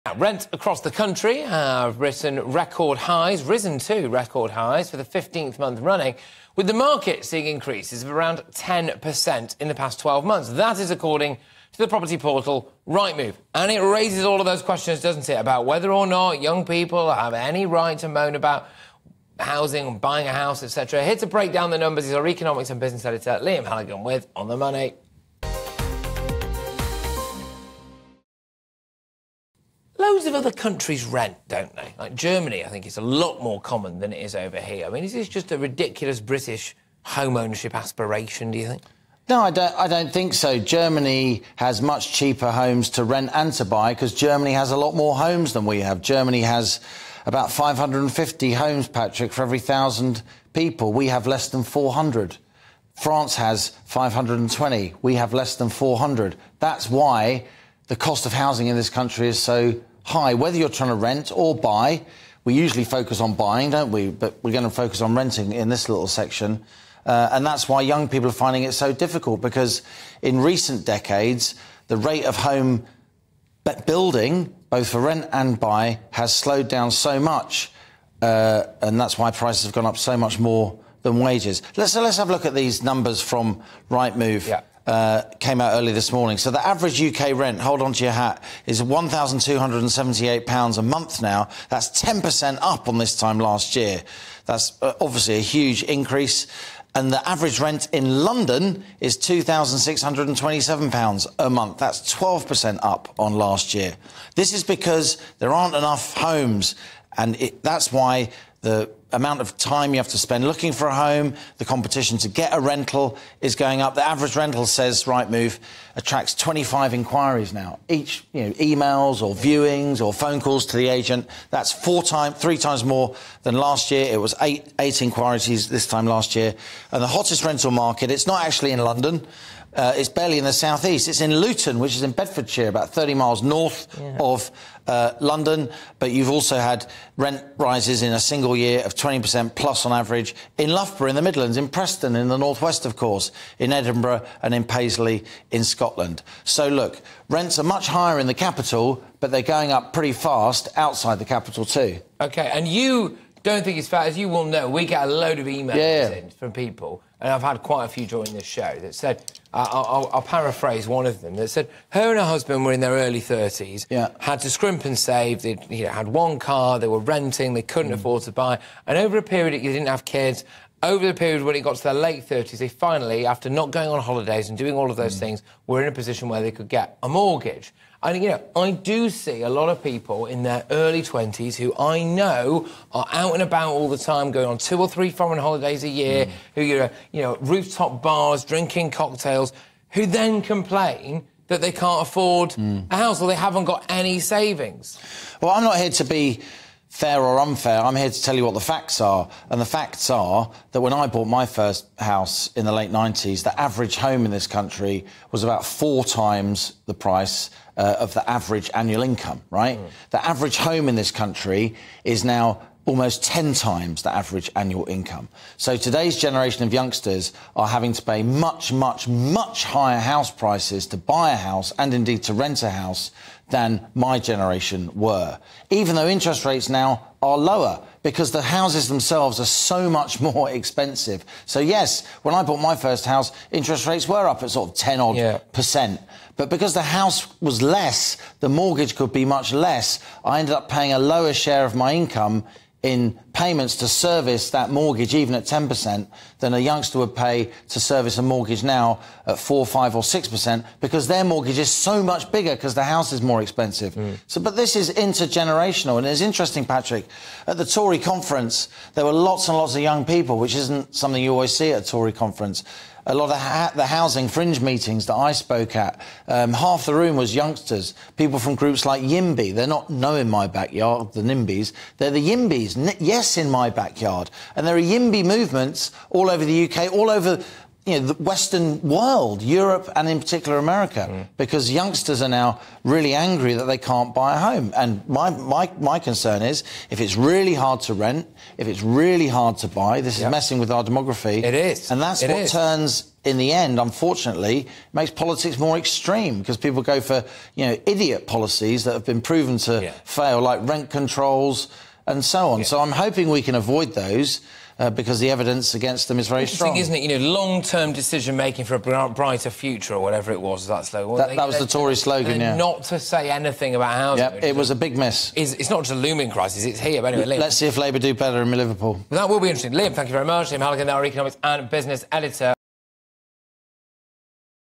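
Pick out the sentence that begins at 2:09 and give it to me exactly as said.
Uh, it's barely in the southeast.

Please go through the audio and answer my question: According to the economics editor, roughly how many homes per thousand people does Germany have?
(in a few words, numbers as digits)
550.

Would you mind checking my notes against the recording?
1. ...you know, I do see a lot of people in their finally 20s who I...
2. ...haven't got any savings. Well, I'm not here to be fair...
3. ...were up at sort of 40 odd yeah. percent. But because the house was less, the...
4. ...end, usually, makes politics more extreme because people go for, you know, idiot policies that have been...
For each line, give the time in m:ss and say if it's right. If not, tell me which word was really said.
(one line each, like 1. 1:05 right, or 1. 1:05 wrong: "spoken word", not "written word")
1. 2:58 wrong: "early", not "finally"
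2. 3:13 right
3. 3:54 wrong: "10", not "40"
4. 4:53 wrong: "unfortunately", not "usually".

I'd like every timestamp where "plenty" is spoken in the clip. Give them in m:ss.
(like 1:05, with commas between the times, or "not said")
not said.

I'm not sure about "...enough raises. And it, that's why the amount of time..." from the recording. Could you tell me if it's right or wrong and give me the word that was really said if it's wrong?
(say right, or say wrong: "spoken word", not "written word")
wrong: "homes", not "raises".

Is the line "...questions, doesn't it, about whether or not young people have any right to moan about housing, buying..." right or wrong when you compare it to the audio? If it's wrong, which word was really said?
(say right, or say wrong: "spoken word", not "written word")
right.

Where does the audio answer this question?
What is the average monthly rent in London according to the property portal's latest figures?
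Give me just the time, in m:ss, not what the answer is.
1:39.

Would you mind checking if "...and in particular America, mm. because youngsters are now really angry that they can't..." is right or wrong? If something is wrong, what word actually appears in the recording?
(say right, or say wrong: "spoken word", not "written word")
right.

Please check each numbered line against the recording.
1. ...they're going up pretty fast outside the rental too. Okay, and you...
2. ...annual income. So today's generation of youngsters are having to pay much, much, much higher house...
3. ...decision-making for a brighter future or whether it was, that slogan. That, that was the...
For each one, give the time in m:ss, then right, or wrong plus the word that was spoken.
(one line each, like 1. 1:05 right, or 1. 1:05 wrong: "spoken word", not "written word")
1. 2:29 wrong: "capital", not "rental"
2. 3:34 right
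3. 5:07 wrong: "whatever", not "whether".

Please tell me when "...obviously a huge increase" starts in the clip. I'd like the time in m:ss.
1:34.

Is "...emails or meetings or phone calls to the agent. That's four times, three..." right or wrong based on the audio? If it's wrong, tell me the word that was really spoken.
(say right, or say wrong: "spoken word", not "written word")
wrong: "viewings", not "meetings".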